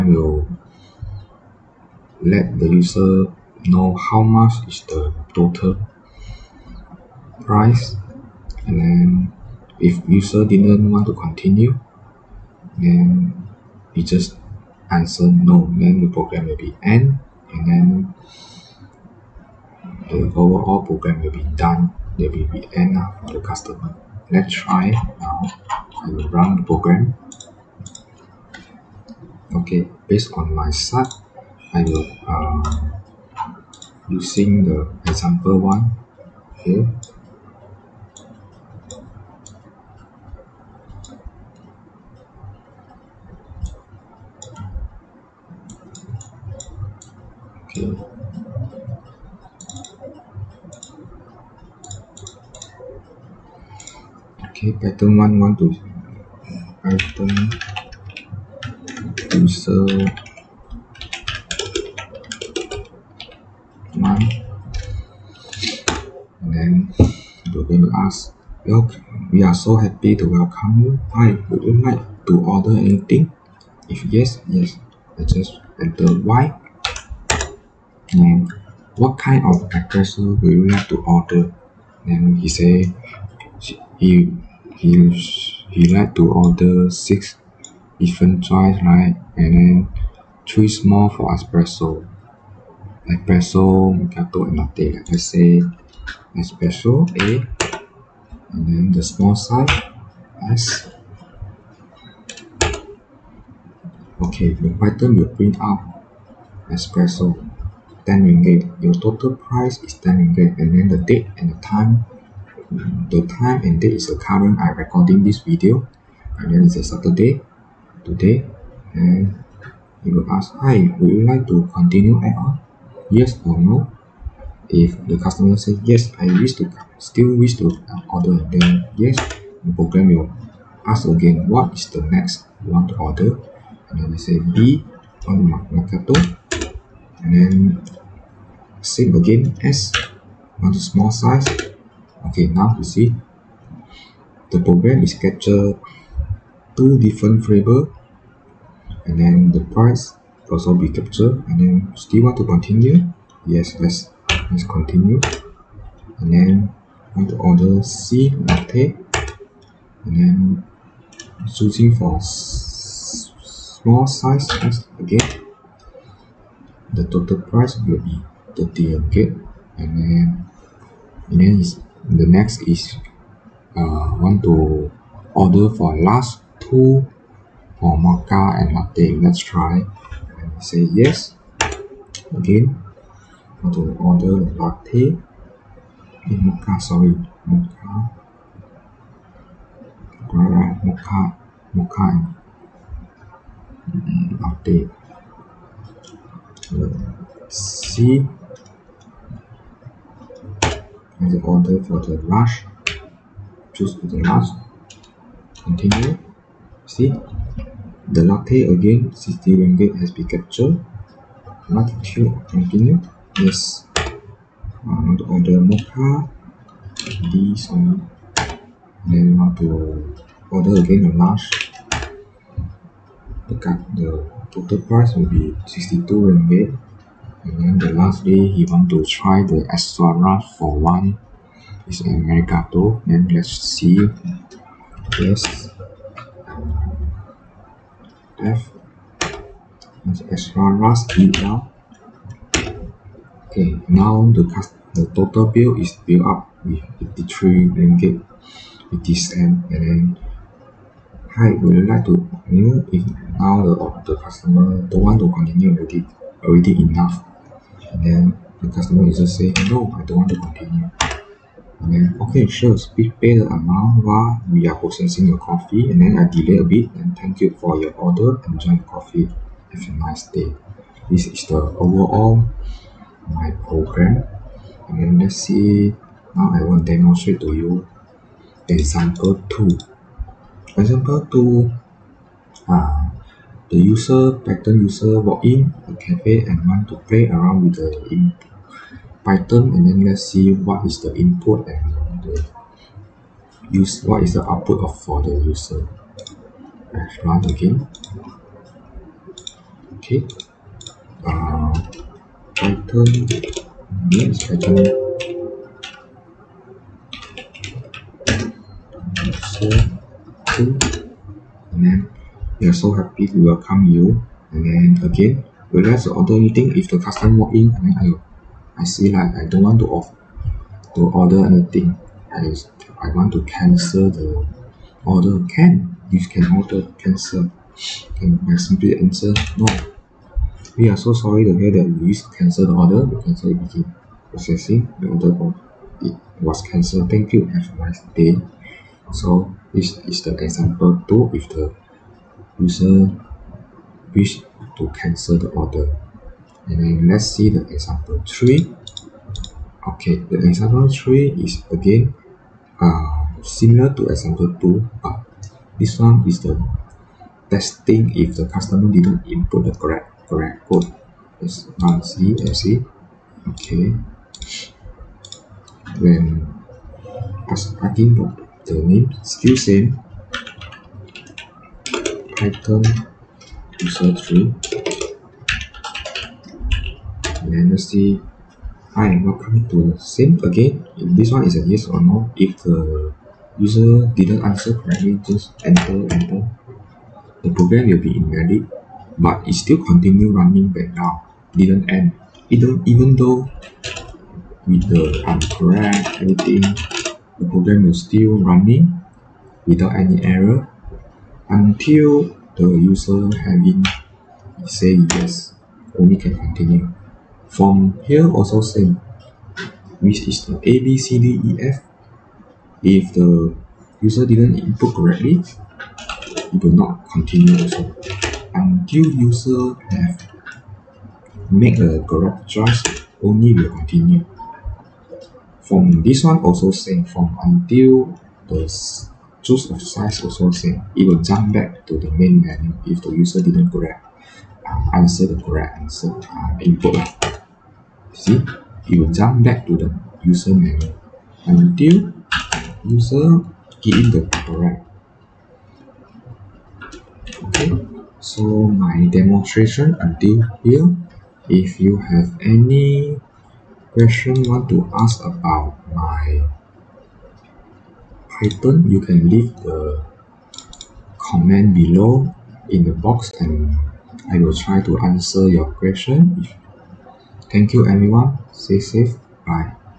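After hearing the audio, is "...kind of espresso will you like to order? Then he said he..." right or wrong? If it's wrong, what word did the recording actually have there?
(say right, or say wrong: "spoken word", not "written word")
right.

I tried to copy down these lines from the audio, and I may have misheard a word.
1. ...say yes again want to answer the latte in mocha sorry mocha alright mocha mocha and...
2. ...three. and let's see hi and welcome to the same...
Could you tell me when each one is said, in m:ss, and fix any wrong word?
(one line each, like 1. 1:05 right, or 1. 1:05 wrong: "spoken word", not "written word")
1. 3:00 wrong: "order", not "answer"
2. 6:14 right.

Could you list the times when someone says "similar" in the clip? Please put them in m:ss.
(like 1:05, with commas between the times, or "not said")
5:53.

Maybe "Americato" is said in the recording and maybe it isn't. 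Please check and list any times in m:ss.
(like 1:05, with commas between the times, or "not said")
3:52.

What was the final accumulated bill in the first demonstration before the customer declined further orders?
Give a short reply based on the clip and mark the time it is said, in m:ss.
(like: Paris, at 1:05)
83 ringgit, at 4:07.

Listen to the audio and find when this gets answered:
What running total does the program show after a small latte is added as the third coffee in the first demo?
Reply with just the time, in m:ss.
2:48.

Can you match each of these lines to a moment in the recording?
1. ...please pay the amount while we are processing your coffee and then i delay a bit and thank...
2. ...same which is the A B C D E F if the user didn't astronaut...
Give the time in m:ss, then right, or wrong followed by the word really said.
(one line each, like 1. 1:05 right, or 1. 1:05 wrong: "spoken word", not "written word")
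1. 4:22 right
2. 6:48 wrong: "input", not "astronaut".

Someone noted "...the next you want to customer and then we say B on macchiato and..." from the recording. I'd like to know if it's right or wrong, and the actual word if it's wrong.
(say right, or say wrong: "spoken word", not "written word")
wrong: "order", not "customer".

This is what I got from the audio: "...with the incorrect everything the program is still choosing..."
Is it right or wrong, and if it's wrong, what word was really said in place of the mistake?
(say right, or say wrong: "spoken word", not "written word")
wrong: "running", not "choosing".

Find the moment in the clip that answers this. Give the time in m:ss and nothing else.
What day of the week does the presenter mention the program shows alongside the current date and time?
1:56.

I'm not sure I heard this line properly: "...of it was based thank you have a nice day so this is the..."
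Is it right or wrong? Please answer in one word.
wrong.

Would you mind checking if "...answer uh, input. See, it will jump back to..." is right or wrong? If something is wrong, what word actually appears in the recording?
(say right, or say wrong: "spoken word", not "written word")
right.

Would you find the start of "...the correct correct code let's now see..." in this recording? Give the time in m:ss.
5:59.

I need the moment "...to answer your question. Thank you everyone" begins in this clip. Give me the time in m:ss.
7:44.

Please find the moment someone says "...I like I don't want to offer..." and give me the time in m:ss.
5:18.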